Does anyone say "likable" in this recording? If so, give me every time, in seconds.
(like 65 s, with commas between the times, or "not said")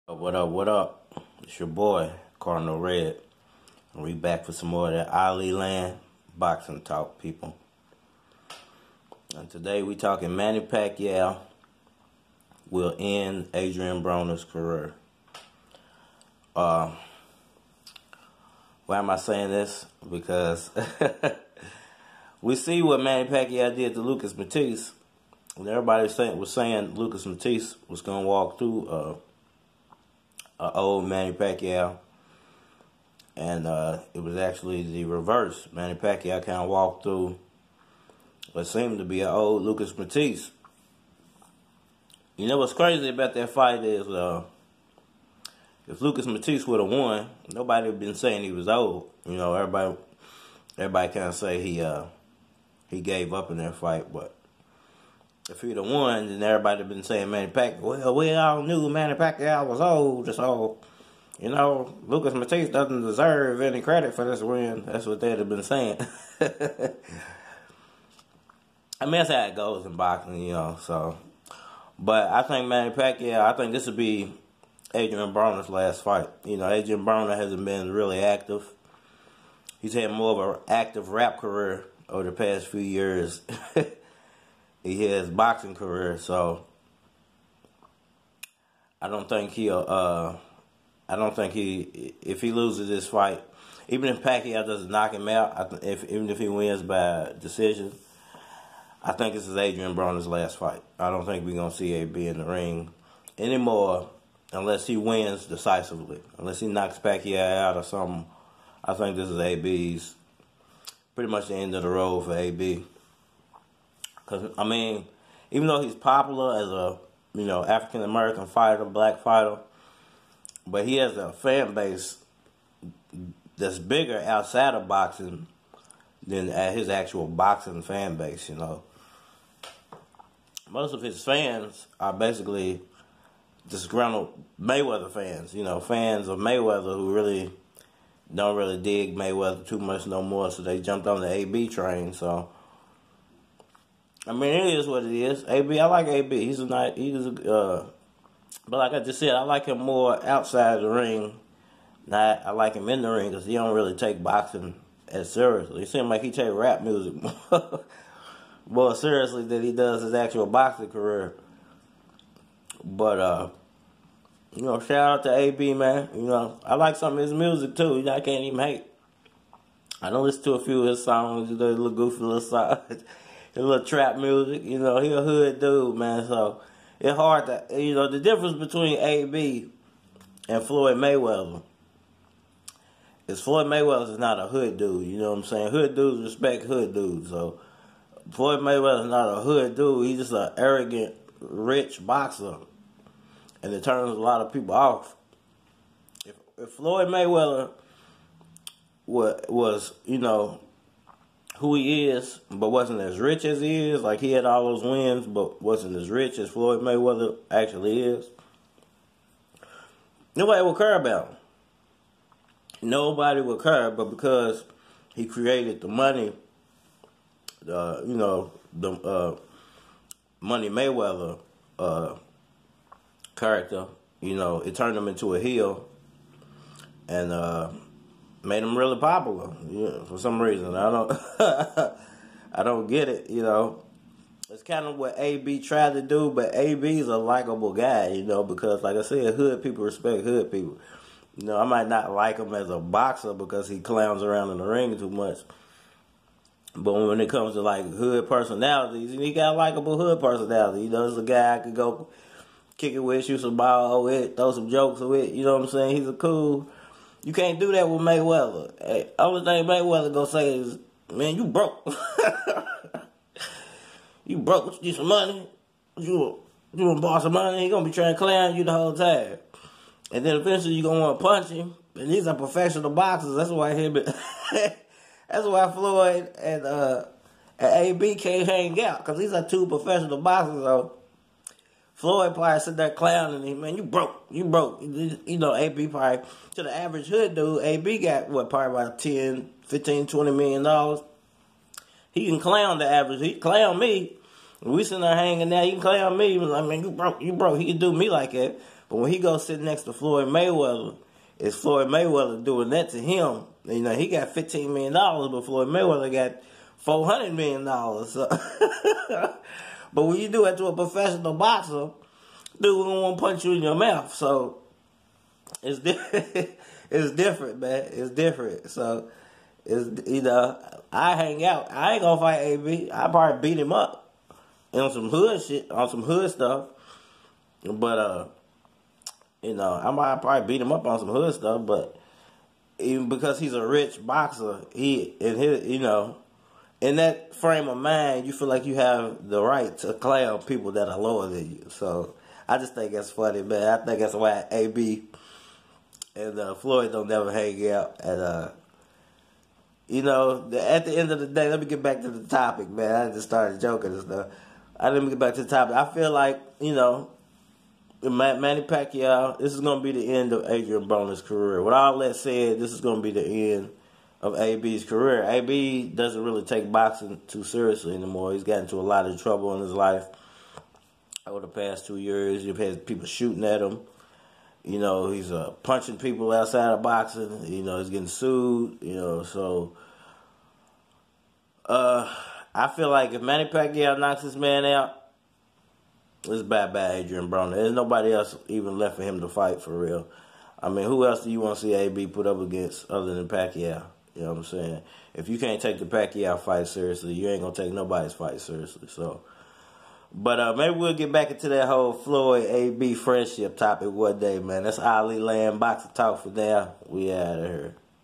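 237 s, 249 s.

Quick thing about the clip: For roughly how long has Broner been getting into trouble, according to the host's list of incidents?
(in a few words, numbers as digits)
2 years.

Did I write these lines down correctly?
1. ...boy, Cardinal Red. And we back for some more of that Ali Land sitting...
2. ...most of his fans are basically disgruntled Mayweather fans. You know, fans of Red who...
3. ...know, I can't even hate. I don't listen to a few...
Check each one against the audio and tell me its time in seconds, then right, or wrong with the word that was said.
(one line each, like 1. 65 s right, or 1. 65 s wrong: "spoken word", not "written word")
1. 1 s wrong: "boxing", not "sitting"
2. 130 s wrong: "Mayweather", not "Red"
3. 168 s right.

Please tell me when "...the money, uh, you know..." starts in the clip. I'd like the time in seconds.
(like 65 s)
215 s.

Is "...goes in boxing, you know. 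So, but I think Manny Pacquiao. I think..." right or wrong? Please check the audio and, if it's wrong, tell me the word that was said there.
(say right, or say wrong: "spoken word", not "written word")
right.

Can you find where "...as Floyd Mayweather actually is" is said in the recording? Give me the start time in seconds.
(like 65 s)
206 s.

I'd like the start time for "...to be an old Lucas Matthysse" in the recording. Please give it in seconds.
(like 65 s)
38 s.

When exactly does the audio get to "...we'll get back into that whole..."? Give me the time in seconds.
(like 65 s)
400 s.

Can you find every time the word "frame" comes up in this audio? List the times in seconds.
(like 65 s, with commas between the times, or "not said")
337 s.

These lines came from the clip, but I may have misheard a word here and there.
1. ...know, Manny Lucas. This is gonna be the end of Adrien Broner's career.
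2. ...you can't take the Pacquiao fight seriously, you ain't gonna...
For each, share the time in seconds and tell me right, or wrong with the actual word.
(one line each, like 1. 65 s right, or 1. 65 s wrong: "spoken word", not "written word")
1. 356 s wrong: "Pacquiao", not "Lucas"
2. 395 s right.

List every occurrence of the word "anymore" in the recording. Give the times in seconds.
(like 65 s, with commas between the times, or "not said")
103 s, 367 s.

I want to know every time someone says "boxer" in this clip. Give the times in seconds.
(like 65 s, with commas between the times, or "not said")
192 s, 242 s, 272 s, 280 s, 311 s, 334 s.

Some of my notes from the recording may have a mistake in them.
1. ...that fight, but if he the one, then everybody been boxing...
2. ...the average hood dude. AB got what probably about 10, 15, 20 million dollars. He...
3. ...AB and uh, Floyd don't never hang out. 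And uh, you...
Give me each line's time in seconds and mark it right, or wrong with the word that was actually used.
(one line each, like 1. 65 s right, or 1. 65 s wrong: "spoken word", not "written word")
1. 53 s wrong: "saying", not "boxing"
2. 286 s right
3. 344 s right.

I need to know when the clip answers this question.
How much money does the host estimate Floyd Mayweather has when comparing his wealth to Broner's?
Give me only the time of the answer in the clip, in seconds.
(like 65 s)
306 s.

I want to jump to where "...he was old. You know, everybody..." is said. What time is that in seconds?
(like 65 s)
48 s.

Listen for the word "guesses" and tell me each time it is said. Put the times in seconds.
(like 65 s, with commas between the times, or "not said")
not said.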